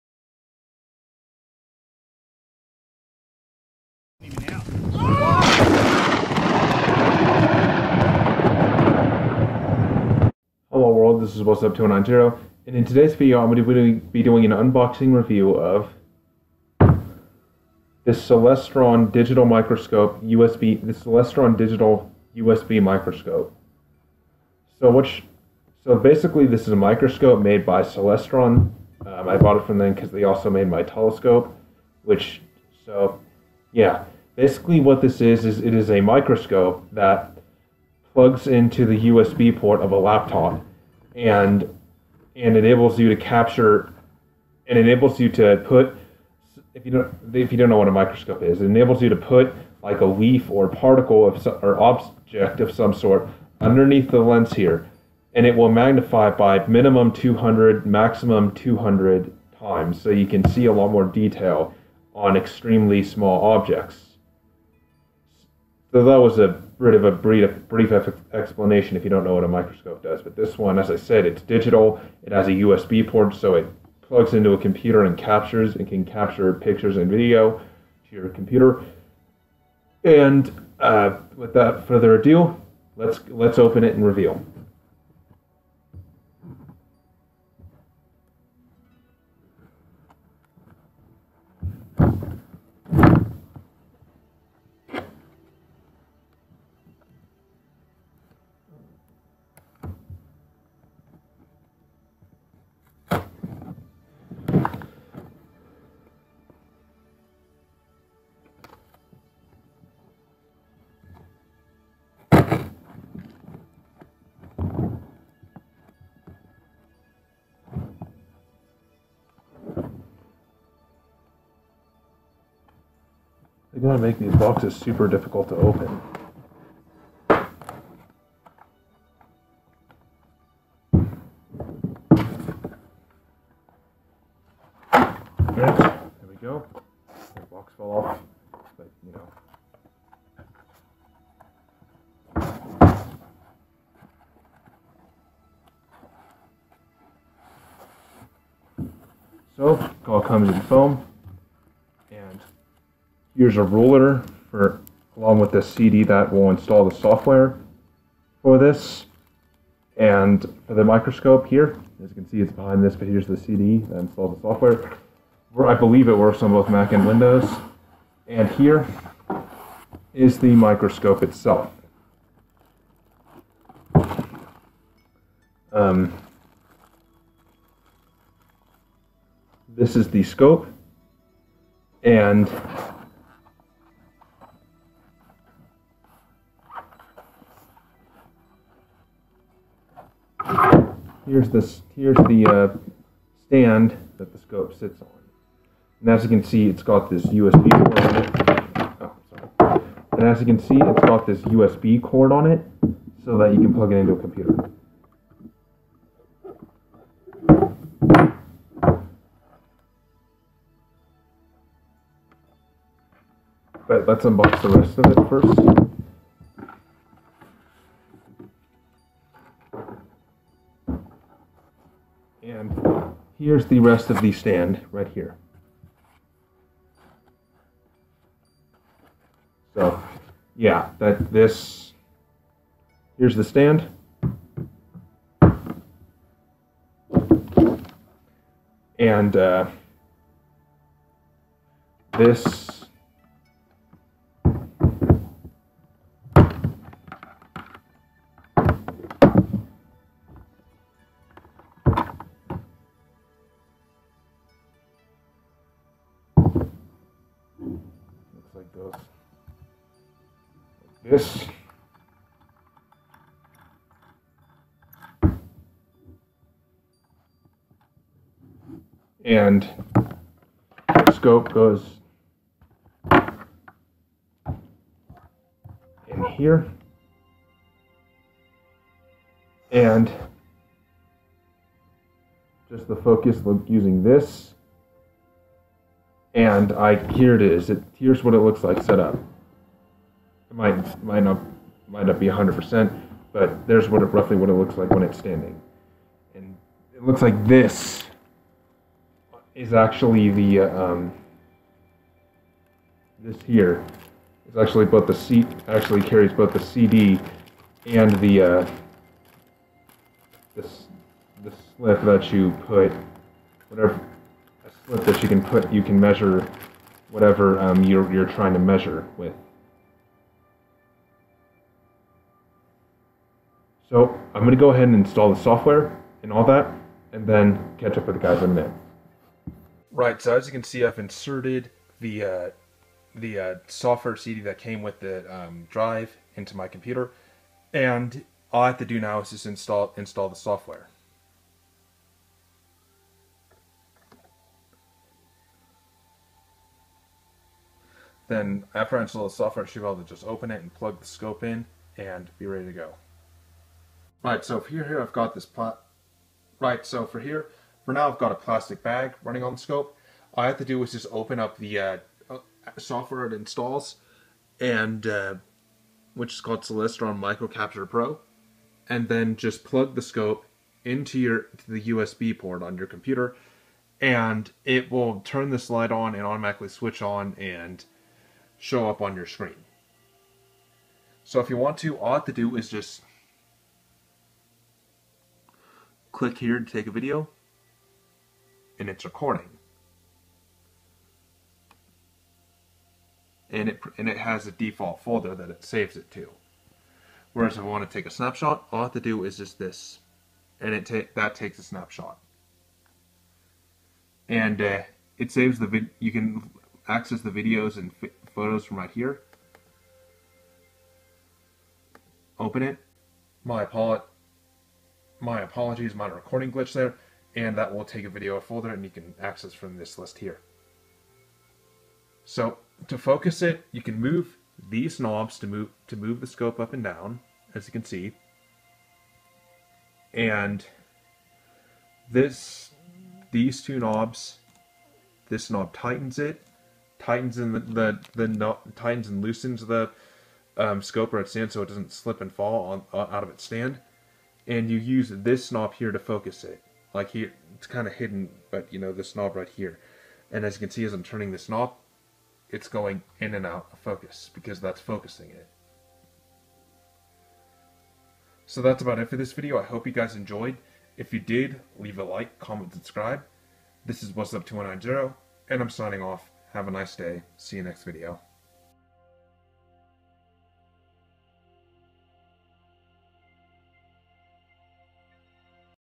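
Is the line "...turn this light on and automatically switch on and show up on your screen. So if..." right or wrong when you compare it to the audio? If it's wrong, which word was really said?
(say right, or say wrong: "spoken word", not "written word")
right.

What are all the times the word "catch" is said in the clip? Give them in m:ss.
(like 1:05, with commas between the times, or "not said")
5:27.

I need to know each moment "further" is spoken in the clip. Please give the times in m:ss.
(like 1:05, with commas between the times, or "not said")
1:21.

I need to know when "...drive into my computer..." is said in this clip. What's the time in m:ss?
5:35.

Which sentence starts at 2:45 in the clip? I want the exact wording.
I believe it works on both Mac and Windows.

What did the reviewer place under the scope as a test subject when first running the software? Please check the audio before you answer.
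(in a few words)
A plastic bag.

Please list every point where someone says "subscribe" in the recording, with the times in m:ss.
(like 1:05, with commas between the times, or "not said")
7:42.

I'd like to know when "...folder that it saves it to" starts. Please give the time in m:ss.
6:35.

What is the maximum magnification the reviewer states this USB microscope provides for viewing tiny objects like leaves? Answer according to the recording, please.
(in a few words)
200 times.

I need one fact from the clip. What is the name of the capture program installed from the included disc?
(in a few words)
Celestron Microcapture Pro.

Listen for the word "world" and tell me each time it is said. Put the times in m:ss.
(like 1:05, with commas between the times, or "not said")
0:10.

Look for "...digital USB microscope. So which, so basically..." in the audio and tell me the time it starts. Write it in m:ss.
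0:21.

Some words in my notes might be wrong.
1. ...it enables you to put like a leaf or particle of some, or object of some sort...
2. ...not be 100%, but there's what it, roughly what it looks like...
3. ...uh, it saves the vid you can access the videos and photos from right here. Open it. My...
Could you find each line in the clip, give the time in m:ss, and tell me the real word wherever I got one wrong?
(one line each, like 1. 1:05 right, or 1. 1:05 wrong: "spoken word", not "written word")
1. 0:48 right
2. 4:52 right
3. 6:44 right.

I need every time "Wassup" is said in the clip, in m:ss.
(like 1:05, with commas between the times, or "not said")
0:11, 7:44.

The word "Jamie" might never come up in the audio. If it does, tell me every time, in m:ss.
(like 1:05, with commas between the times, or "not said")
not said.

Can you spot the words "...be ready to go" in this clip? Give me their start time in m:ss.
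5:52.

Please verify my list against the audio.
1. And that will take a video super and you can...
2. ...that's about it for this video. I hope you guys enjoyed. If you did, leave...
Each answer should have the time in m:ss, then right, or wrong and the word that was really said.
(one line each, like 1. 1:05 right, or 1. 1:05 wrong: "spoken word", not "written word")
1. 6:57 wrong: "folder", not "super"
2. 7:38 right.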